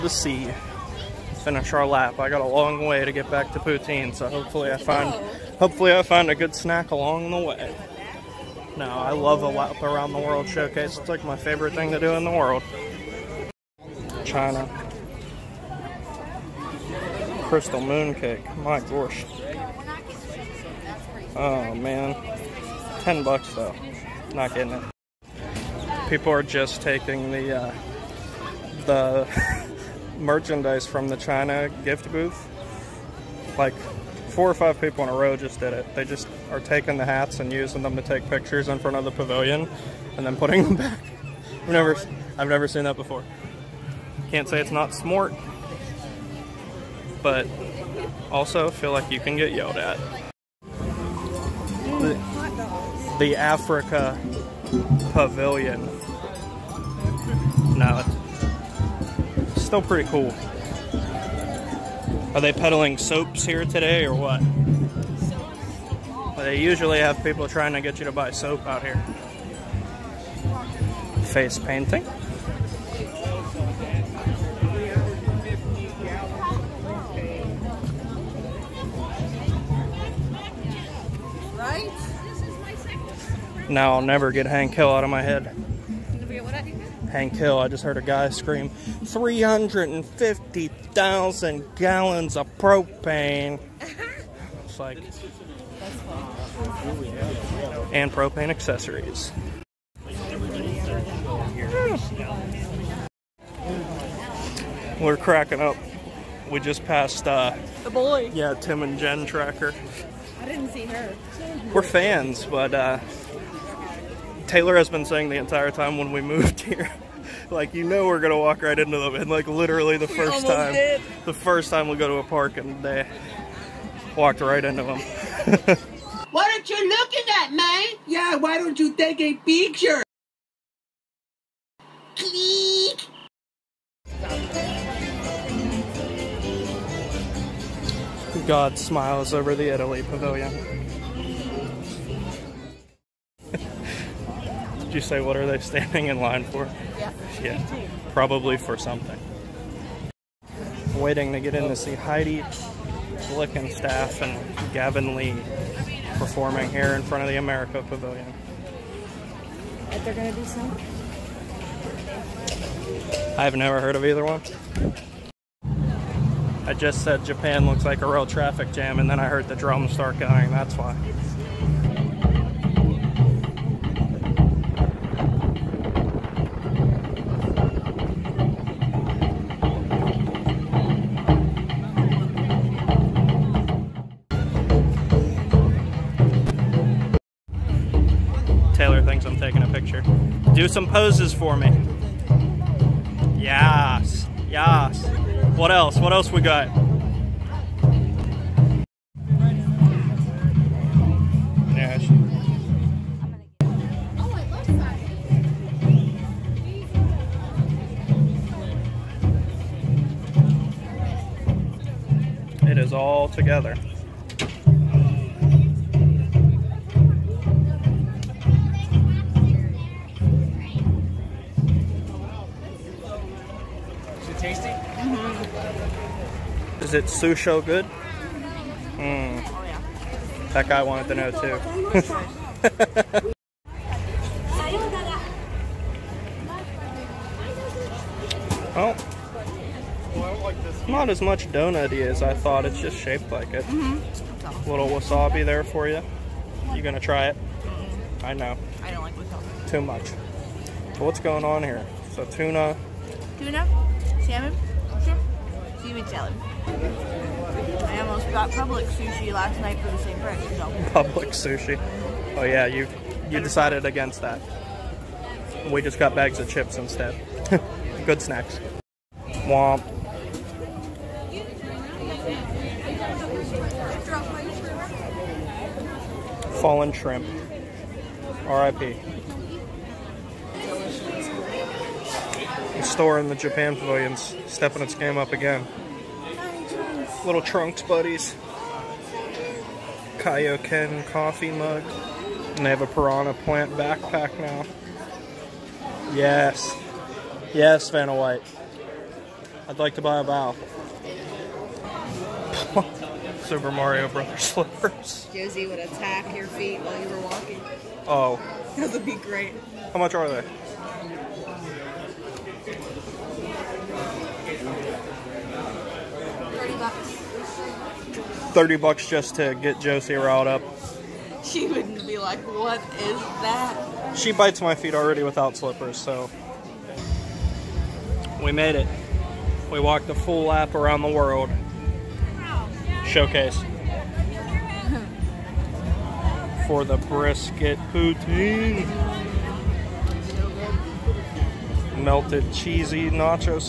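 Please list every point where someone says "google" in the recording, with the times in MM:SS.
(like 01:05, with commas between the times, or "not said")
not said.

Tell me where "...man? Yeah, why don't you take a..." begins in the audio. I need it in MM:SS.
02:07.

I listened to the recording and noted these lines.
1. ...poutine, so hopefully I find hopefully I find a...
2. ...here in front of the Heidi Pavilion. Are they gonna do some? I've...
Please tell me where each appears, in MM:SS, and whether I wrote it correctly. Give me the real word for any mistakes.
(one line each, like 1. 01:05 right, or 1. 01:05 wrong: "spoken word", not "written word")
1. 00:03 right
2. 02:36 wrong: "America", not "Heidi".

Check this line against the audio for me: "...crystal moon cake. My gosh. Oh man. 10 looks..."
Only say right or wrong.
wrong.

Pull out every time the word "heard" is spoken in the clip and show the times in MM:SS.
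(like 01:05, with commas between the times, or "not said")
01:27, 02:43, 02:49.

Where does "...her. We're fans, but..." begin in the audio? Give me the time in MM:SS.
01:50.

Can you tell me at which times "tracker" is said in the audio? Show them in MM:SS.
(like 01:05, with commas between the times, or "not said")
01:49.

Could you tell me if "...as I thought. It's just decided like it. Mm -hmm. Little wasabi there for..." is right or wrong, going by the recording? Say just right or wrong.
wrong.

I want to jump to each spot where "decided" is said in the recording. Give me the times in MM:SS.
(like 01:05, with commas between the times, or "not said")
04:23.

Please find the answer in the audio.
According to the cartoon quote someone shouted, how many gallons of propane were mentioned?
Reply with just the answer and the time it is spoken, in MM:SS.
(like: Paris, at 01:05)
350,000, at 01:28.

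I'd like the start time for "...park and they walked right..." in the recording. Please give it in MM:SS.
02:02.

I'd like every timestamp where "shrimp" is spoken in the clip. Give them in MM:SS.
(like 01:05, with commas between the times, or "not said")
04:15, 04:36.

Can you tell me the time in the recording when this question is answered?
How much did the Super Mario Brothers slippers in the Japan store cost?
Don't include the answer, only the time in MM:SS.
05:18.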